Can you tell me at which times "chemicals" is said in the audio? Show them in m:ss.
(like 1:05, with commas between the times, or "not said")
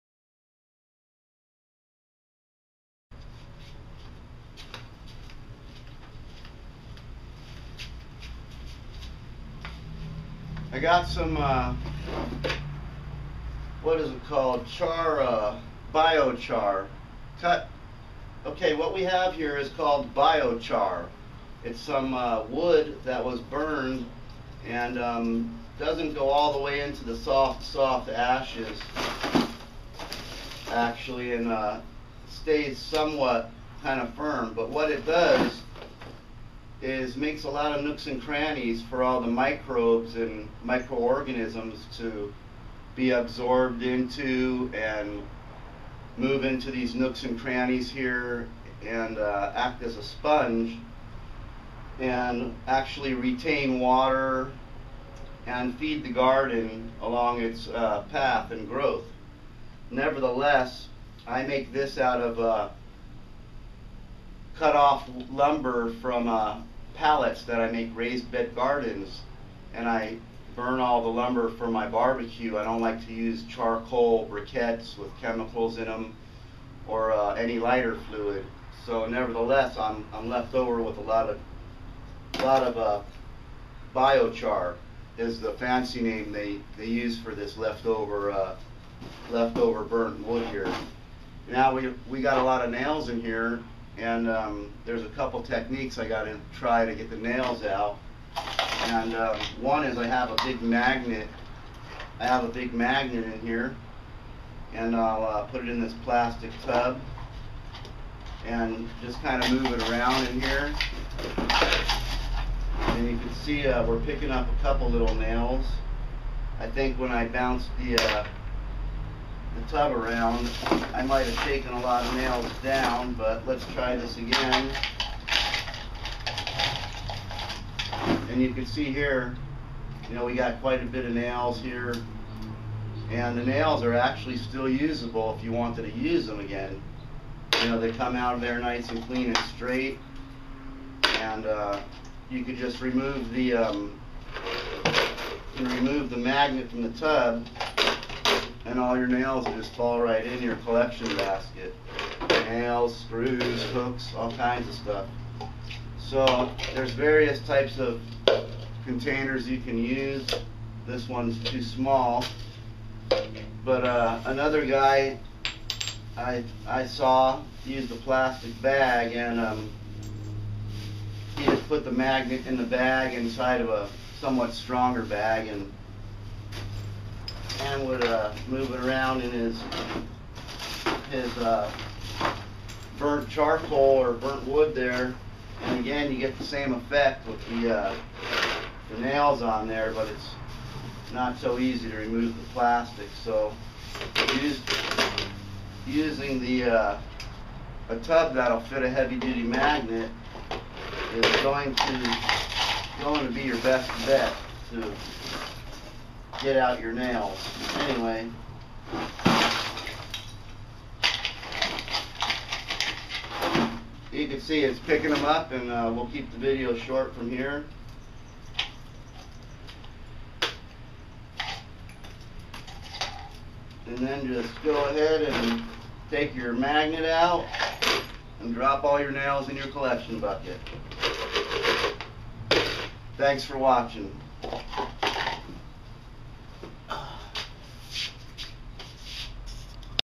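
1:15.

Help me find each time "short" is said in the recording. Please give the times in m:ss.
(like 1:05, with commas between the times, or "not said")
3:36.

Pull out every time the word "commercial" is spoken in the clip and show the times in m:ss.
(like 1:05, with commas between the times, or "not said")
not said.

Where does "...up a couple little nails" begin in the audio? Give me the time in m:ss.
1:54.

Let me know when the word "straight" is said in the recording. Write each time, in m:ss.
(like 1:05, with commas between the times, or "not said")
2:19.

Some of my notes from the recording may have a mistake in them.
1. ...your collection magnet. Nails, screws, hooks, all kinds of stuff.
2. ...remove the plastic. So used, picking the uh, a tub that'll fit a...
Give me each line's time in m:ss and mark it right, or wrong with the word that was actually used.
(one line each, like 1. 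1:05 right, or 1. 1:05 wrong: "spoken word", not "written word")
1. 2:30 wrong: "basket", not "magnet"
2. 3:11 wrong: "using", not "picking".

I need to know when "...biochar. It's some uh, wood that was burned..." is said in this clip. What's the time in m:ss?
0:20.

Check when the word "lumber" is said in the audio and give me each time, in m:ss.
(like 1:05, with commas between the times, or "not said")
1:05, 1:11.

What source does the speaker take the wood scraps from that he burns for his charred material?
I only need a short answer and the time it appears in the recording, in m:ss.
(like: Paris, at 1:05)
pallets, at 1:06.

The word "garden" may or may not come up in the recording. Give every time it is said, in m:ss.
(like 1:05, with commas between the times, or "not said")
0:56, 1:08.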